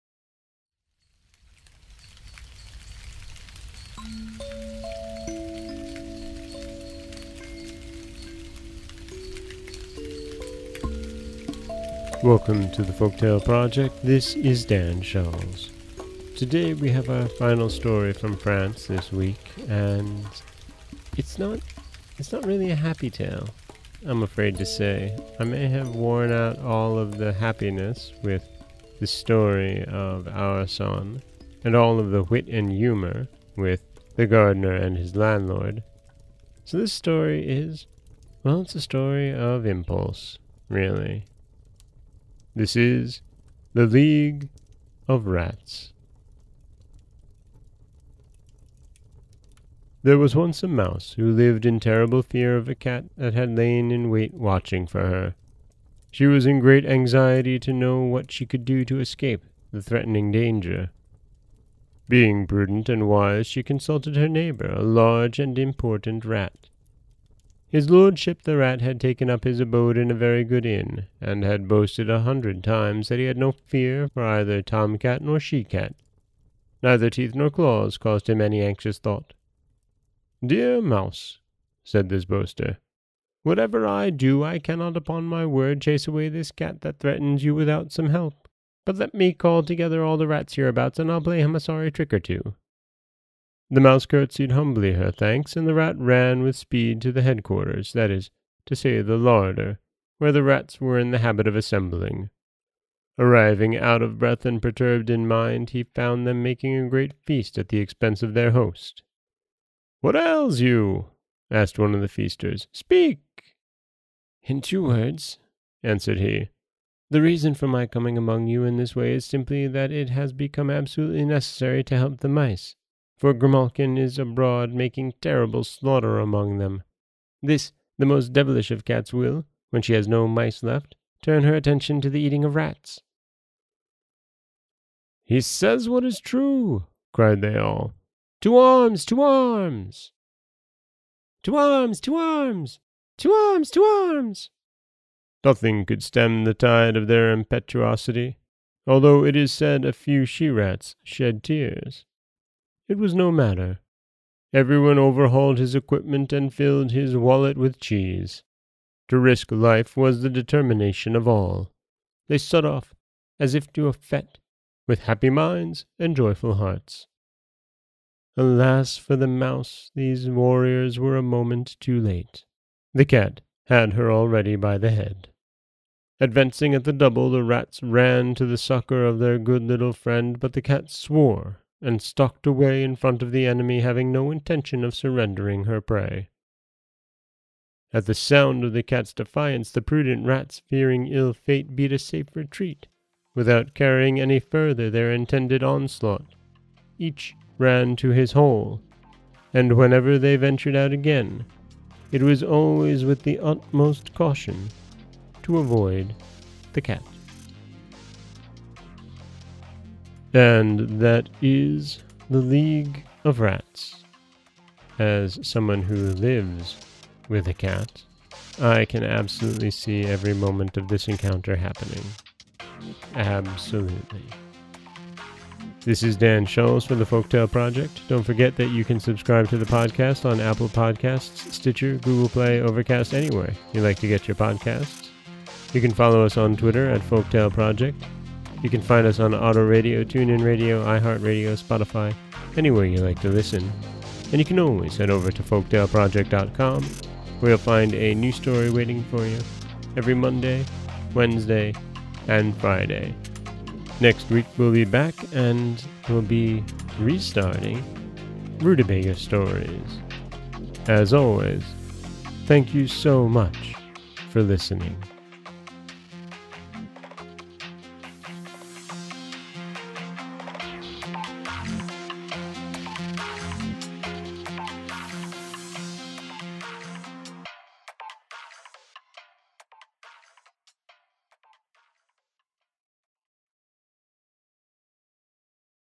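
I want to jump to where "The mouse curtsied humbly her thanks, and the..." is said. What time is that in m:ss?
1:33.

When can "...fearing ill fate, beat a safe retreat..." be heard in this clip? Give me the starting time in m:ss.
3:10.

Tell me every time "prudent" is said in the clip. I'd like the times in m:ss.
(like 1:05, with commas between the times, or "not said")
1:02, 3:09.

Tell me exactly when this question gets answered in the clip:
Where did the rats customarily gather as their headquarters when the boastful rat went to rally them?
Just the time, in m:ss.
1:39.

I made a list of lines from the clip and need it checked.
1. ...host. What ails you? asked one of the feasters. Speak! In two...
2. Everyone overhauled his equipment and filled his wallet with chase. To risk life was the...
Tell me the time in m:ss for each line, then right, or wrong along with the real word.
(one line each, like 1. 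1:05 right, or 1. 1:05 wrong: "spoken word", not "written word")
1. 1:48 right
2. 2:34 wrong: "cheese", not "chase".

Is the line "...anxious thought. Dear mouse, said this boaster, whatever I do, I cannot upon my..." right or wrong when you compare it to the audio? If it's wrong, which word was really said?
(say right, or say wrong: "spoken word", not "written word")
right.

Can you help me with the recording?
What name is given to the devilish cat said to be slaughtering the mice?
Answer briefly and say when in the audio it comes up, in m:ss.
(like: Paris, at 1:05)
Grimalkin, at 2:03.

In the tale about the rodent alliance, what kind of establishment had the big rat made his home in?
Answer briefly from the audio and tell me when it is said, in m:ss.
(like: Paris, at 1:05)
a very good inn, at 1:10.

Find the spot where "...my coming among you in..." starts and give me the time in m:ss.
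1:57.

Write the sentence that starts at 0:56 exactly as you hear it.
She was in great anxiety to know what she could do to escape the threatening danger.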